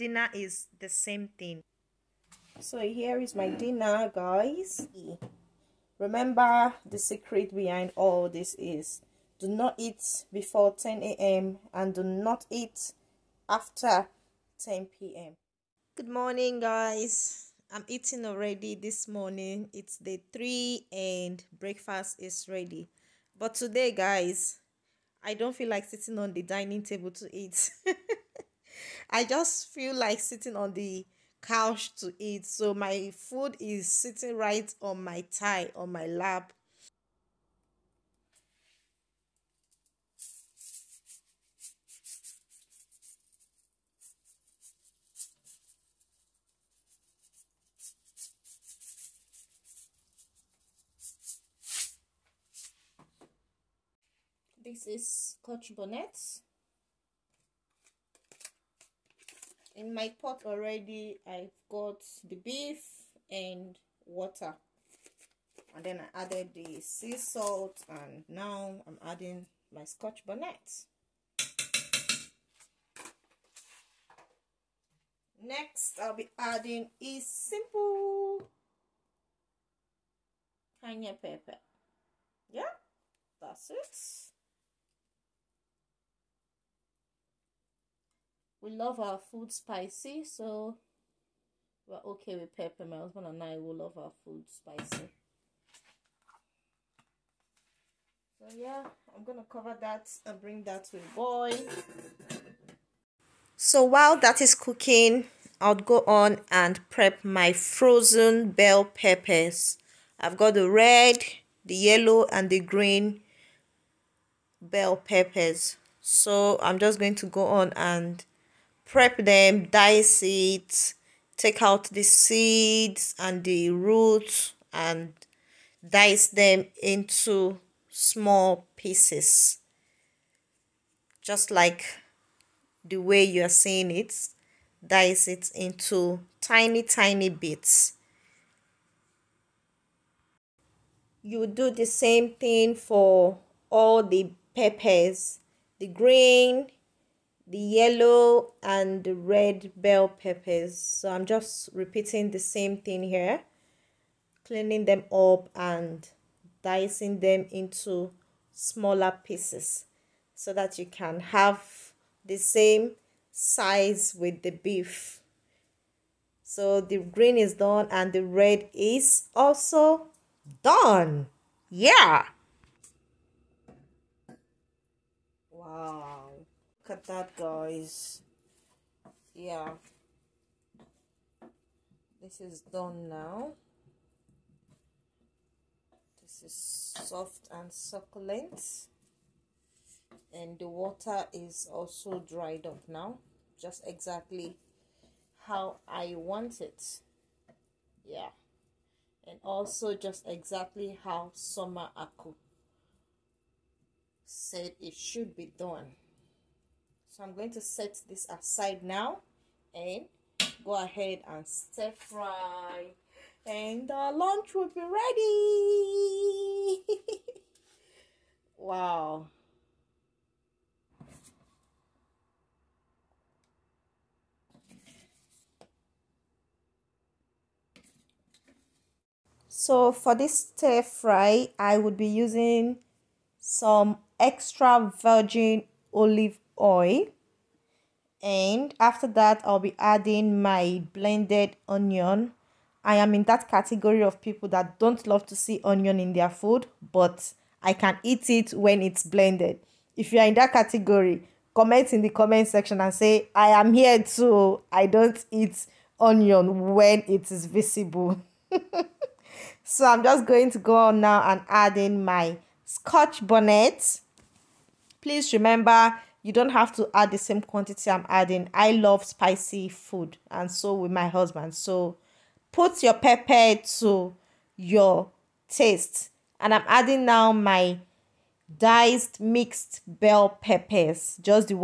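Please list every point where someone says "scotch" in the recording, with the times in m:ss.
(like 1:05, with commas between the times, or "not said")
0:55, 1:09, 4:22.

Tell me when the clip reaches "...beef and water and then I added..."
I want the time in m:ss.
1:02.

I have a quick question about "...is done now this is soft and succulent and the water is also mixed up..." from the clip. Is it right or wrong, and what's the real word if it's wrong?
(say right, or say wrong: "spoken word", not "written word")
wrong: "dried", not "mixed".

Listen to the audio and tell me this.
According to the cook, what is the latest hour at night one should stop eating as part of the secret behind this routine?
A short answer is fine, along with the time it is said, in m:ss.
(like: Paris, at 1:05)
10 p.m., at 0:14.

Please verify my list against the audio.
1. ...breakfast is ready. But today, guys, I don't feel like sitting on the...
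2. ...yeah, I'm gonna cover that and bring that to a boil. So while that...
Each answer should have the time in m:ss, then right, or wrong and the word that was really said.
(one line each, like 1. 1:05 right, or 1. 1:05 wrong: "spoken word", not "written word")
1. 0:21 right
2. 1:38 right.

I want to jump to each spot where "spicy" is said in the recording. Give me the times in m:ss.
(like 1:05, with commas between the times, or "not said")
1:29, 1:34, 4:29.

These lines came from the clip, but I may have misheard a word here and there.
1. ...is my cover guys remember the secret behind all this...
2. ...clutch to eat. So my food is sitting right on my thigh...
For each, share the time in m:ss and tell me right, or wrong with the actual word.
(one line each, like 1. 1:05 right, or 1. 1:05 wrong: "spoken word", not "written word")
1. 0:03 wrong: "dinner", not "cover"
2. 0:31 wrong: "couch", not "clutch".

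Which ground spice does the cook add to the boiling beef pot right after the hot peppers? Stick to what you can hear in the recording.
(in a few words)
cayenne pepper.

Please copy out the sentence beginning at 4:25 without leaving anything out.
Please remember you don't have to add the same quantity I'm adding.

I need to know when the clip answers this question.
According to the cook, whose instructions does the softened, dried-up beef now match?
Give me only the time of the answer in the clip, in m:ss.
3:21.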